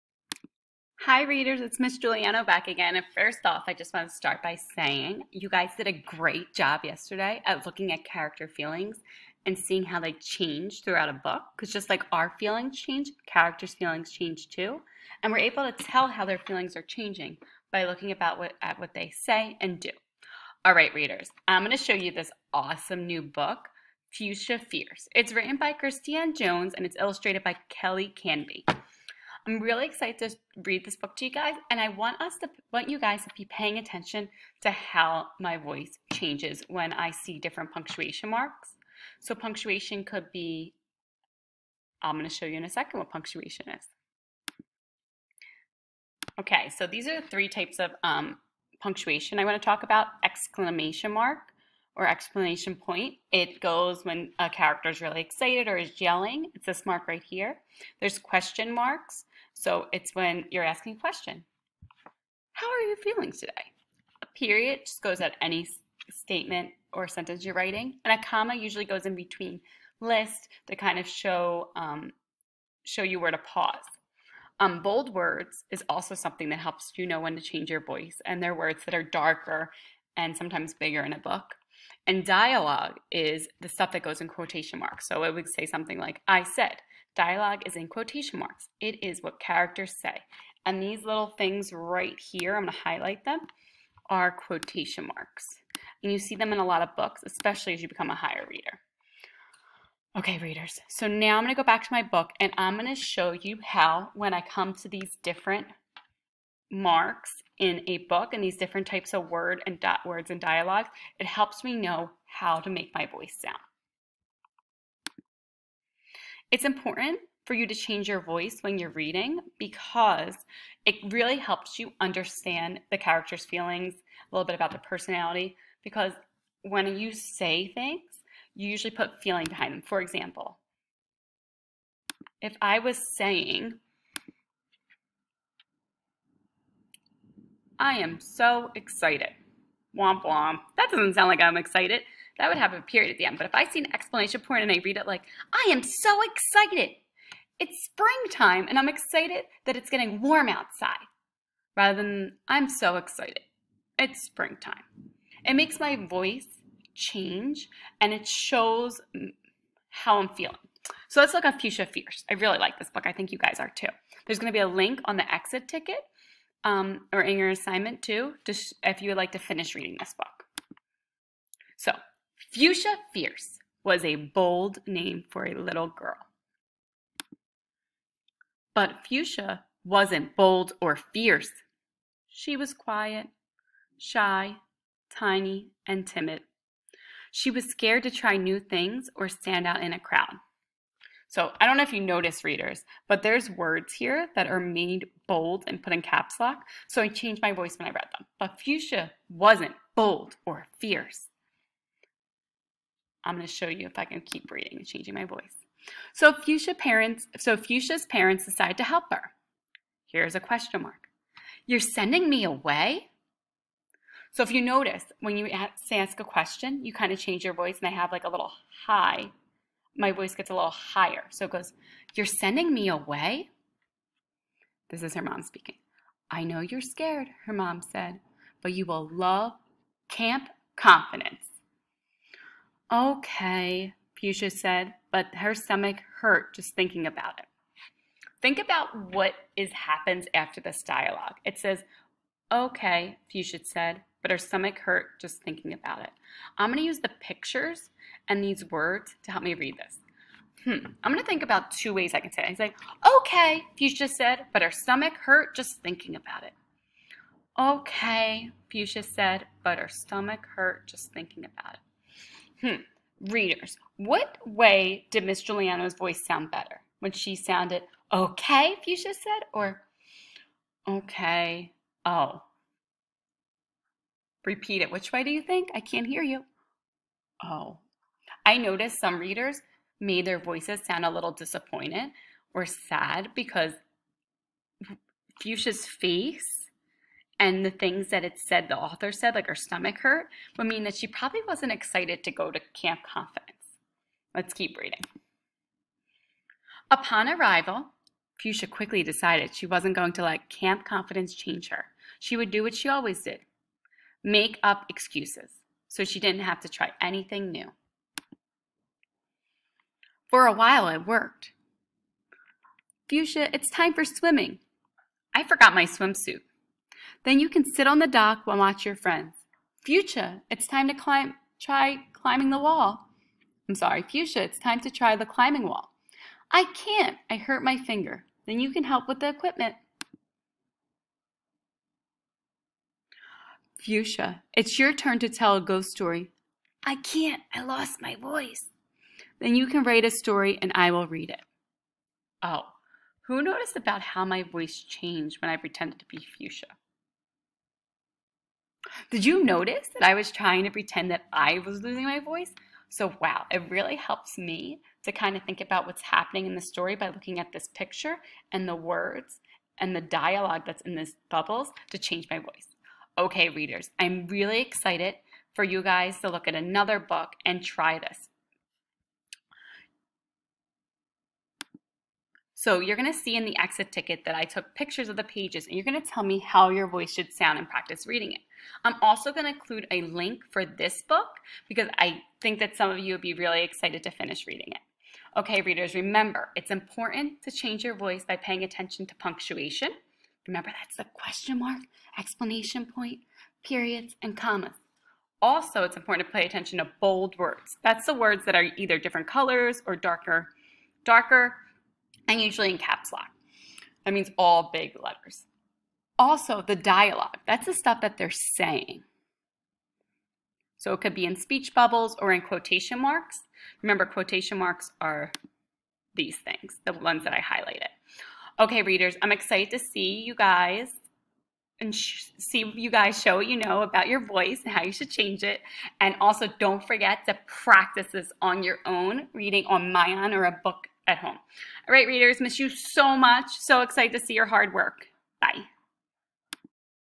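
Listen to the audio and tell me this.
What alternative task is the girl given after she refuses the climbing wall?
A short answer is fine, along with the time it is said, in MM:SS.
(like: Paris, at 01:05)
help with the equipment, at 05:28.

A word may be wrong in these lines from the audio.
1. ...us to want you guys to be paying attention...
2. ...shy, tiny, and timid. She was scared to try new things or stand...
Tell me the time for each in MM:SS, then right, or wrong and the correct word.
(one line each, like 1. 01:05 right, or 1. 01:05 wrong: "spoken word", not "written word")
1. 00:32 right
2. 03:03 right.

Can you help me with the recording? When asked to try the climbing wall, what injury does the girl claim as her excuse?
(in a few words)
hurt my finger.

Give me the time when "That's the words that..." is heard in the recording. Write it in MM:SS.
06:37.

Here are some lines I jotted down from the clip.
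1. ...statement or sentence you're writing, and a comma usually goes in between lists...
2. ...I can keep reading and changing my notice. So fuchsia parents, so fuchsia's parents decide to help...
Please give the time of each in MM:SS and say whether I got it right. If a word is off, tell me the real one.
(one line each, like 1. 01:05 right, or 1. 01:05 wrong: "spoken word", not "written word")
1. 01:06 right
2. 03:23 wrong: "voice", not "notice".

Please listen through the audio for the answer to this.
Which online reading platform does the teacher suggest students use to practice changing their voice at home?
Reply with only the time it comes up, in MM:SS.
07:09.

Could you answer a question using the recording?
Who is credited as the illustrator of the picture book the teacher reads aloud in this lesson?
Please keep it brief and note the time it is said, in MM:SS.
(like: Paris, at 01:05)
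Kelly Canby, at 00:27.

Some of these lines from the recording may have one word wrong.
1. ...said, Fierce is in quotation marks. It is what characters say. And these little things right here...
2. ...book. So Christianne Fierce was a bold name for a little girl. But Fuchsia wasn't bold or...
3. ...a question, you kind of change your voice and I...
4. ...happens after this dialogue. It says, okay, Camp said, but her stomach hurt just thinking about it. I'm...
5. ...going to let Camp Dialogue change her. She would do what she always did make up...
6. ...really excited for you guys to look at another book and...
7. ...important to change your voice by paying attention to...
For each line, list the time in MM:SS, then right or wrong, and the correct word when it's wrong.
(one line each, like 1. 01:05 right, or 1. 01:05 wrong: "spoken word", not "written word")
1. 01:26 wrong: "Dialogue", not "Fierce"
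2. 02:50 wrong: "Fuchsia", not "Christianne"
3. 03:36 right
4. 03:59 wrong: "Fuchsia", not "Camp"
5. 04:59 wrong: "Confidence", not "Dialogue"
6. 06:04 right
7. 06:26 right.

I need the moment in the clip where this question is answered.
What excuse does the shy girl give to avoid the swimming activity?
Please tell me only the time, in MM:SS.
05:15.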